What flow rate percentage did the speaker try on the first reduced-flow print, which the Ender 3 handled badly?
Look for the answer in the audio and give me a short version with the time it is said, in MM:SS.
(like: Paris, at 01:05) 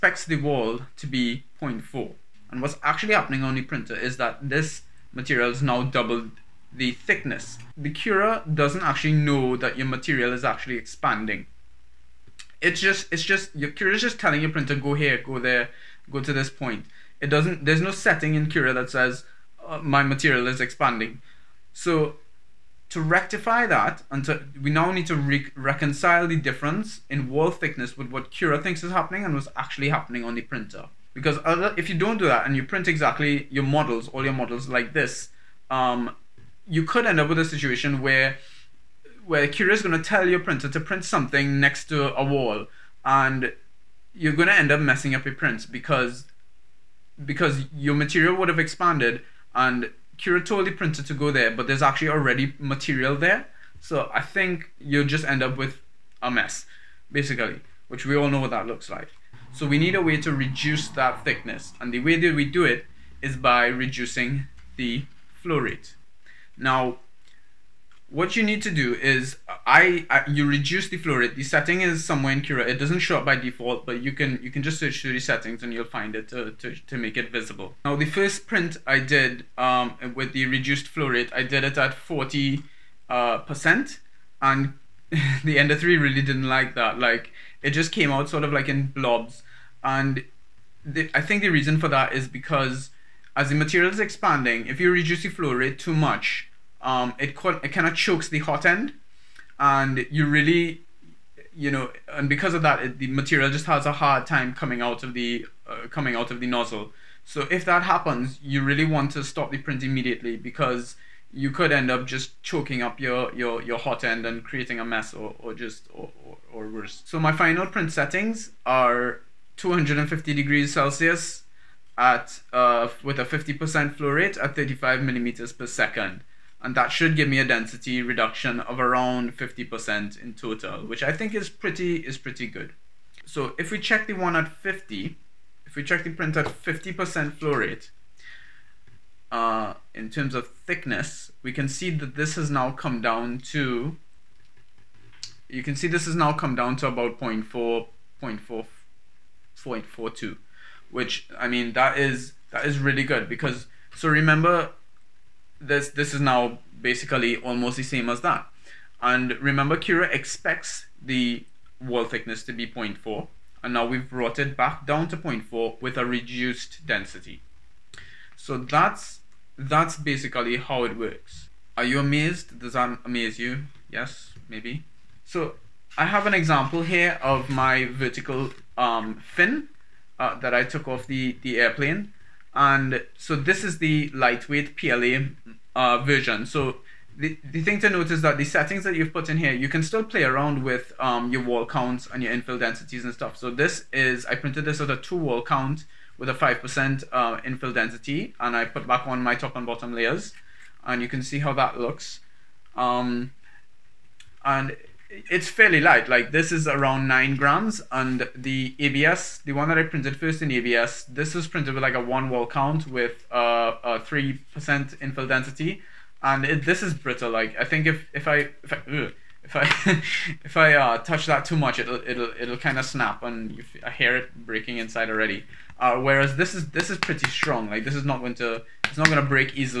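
40%, at 01:21.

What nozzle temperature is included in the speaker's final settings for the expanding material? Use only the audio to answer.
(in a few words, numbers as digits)
250 degrees Celsius.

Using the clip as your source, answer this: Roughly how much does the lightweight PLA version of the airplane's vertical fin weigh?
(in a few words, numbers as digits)
9 grams.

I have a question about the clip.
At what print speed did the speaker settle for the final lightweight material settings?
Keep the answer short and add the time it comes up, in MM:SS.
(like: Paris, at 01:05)
35 mm/s, at 02:04.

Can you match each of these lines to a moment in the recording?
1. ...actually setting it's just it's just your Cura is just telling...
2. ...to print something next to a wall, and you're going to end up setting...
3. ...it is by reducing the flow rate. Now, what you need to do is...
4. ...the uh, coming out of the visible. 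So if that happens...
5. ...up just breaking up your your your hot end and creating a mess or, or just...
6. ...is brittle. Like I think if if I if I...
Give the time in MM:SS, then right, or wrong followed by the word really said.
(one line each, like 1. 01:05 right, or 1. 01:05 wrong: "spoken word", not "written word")
1. 00:10 wrong: "expanding", not "setting"
2. 00:40 wrong: "messing", not "setting"
3. 01:02 right
4. 01:45 wrong: "nozzle", not "visible"
5. 01:51 wrong: "choking", not "breaking"
6. 03:36 right.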